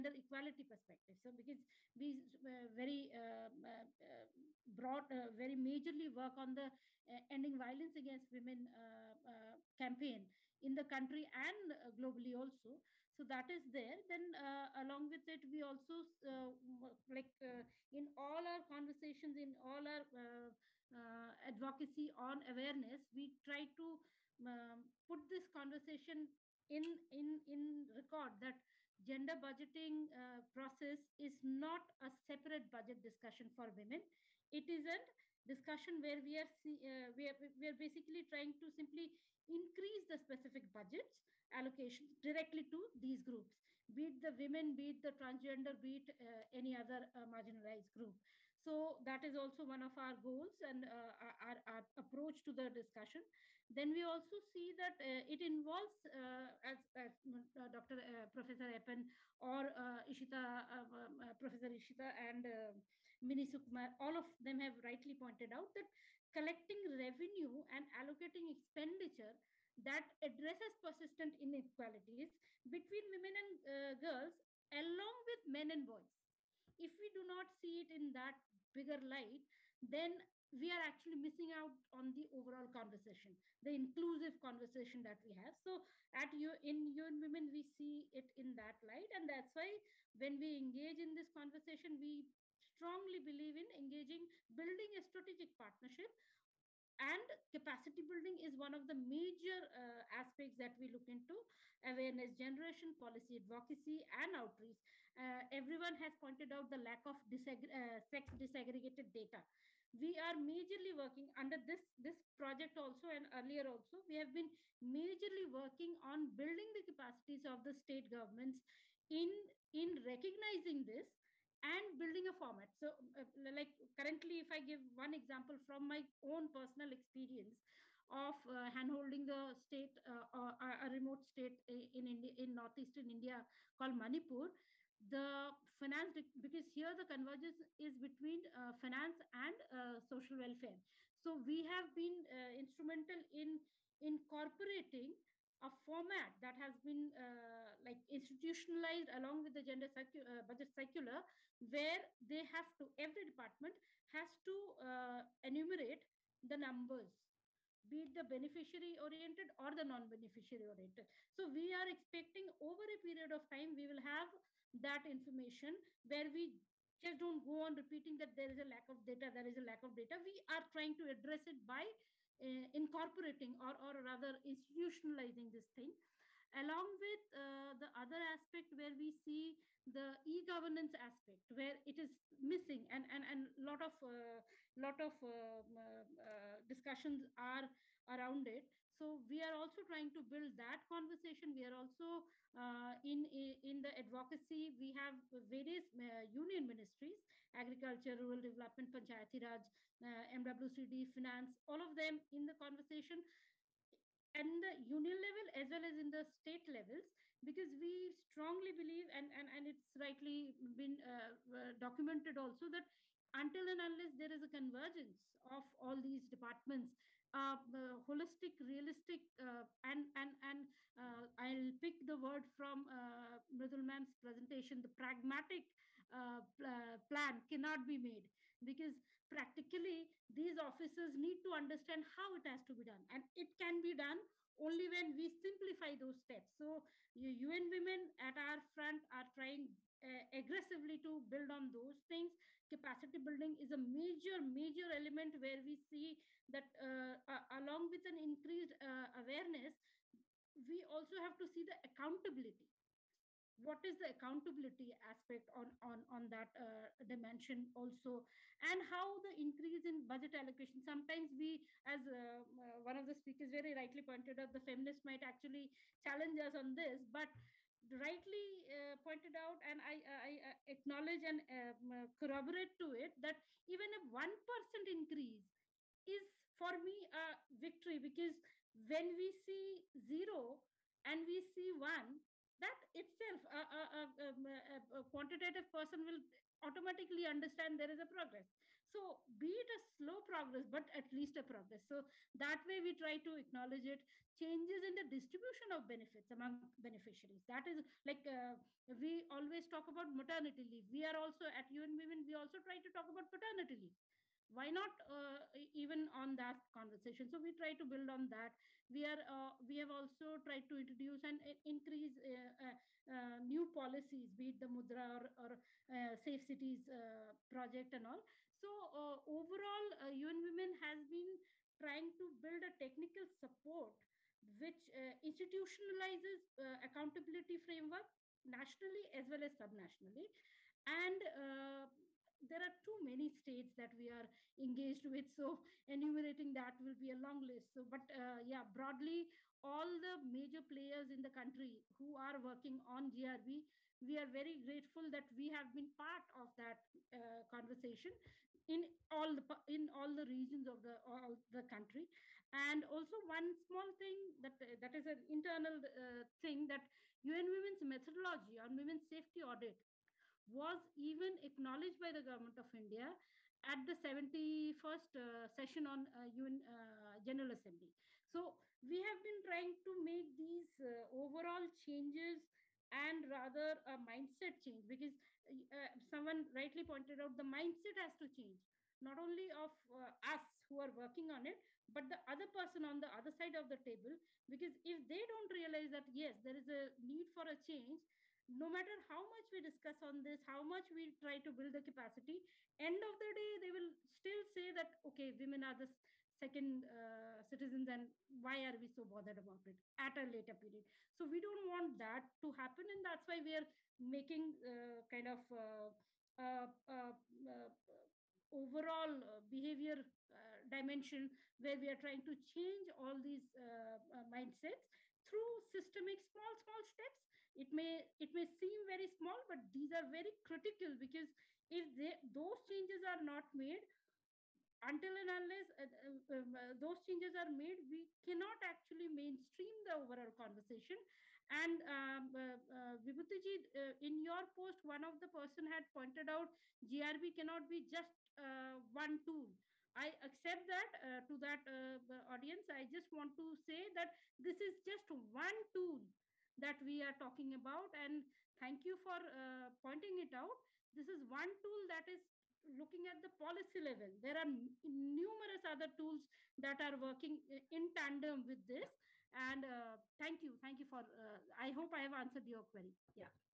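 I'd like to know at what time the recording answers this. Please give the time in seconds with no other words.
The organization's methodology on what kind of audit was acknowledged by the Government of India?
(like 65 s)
358 s.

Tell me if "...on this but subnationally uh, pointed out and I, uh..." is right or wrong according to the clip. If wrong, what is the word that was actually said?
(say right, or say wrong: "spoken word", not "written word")
wrong: "rightly", not "subnationally".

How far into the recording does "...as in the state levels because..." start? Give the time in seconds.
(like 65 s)
205 s.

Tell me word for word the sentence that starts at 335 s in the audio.
So enumerating that will be a long list.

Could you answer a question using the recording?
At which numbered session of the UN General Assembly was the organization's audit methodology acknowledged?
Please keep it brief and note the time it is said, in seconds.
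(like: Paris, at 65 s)
71st, at 363 s.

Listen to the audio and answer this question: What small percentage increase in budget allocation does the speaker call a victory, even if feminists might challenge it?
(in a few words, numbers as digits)
1%.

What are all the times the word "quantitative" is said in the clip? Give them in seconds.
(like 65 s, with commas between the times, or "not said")
285 s.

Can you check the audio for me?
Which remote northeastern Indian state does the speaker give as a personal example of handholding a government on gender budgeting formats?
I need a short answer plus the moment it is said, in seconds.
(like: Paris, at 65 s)
Manipur, at 133 s.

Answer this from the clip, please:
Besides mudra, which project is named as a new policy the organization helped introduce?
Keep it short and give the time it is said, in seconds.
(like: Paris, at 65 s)
safe cities project, at 316 s.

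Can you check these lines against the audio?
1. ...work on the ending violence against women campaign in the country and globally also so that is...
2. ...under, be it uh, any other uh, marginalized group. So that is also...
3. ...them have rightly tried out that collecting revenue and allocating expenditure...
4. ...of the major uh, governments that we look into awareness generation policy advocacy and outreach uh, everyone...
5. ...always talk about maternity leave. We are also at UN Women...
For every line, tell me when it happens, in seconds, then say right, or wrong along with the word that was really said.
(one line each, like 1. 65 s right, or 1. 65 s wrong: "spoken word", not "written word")
1. 6 s right
2. 45 s wrong: "transgender", not "under"
3. 64 s wrong: "pointed", not "tried"
4. 98 s wrong: "aspects", not "governments"
5. 299 s right.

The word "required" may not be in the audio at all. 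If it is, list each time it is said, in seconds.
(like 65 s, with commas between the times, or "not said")
not said.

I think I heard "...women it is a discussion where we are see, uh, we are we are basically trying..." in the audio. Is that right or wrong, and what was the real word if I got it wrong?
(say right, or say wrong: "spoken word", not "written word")
right.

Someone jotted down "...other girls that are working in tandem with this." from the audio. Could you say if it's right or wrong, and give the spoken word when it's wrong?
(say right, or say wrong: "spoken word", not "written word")
wrong: "tools", not "girls".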